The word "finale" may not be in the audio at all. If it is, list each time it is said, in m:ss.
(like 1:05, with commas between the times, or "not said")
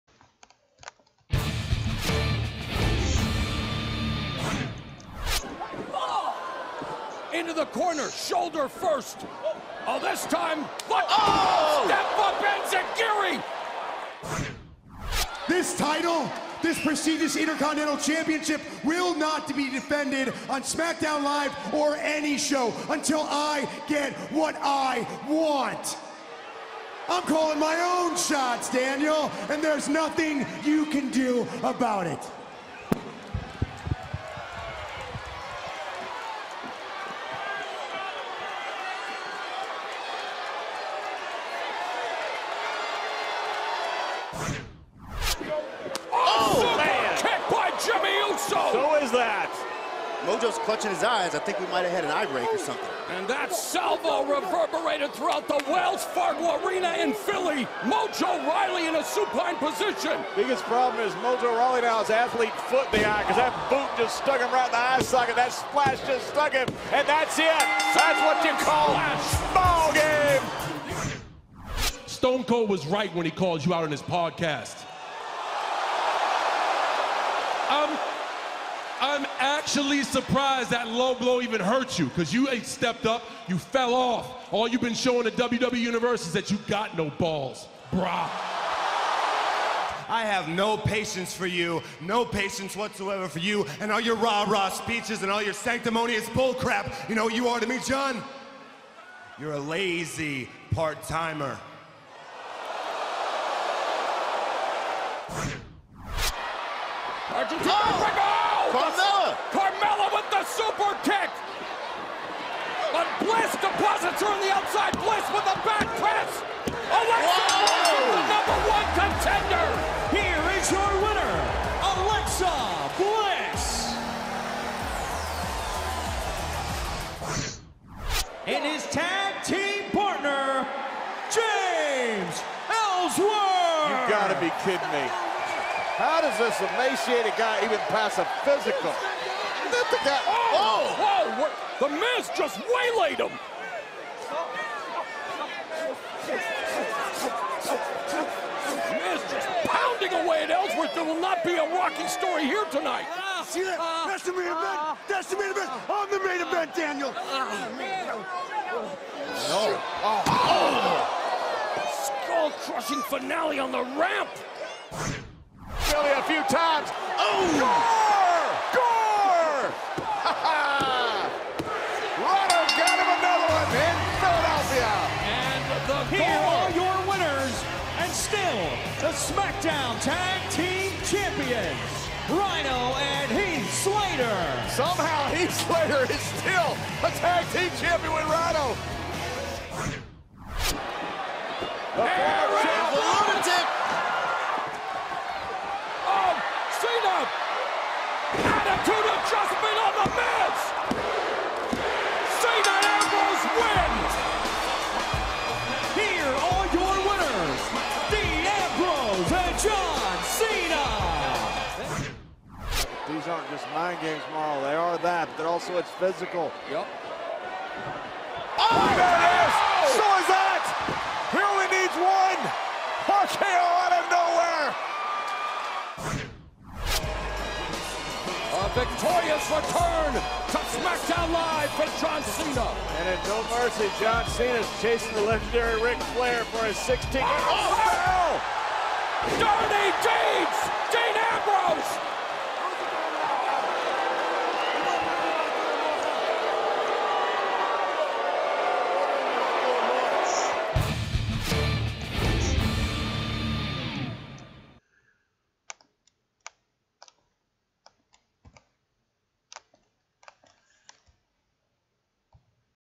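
2:43.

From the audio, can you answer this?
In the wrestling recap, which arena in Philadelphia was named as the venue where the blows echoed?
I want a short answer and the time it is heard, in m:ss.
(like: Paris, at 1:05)
Wells Fargo Arena, at 0:55.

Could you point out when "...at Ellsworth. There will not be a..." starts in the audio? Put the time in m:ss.
2:30.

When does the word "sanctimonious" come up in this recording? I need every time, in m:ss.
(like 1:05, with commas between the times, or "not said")
1:35.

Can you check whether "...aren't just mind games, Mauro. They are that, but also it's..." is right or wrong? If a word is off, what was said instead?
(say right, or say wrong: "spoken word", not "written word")
right.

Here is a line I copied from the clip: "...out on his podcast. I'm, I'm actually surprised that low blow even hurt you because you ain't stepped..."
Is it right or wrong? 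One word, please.
right.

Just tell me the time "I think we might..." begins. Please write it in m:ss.
0:51.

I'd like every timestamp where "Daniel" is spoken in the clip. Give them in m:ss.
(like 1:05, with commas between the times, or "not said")
0:28, 2:36.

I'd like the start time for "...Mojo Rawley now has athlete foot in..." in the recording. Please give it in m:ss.
1:01.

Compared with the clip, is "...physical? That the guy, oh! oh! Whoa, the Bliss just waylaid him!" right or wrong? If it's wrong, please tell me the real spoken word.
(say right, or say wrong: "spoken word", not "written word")
wrong: "Miz", not "Bliss".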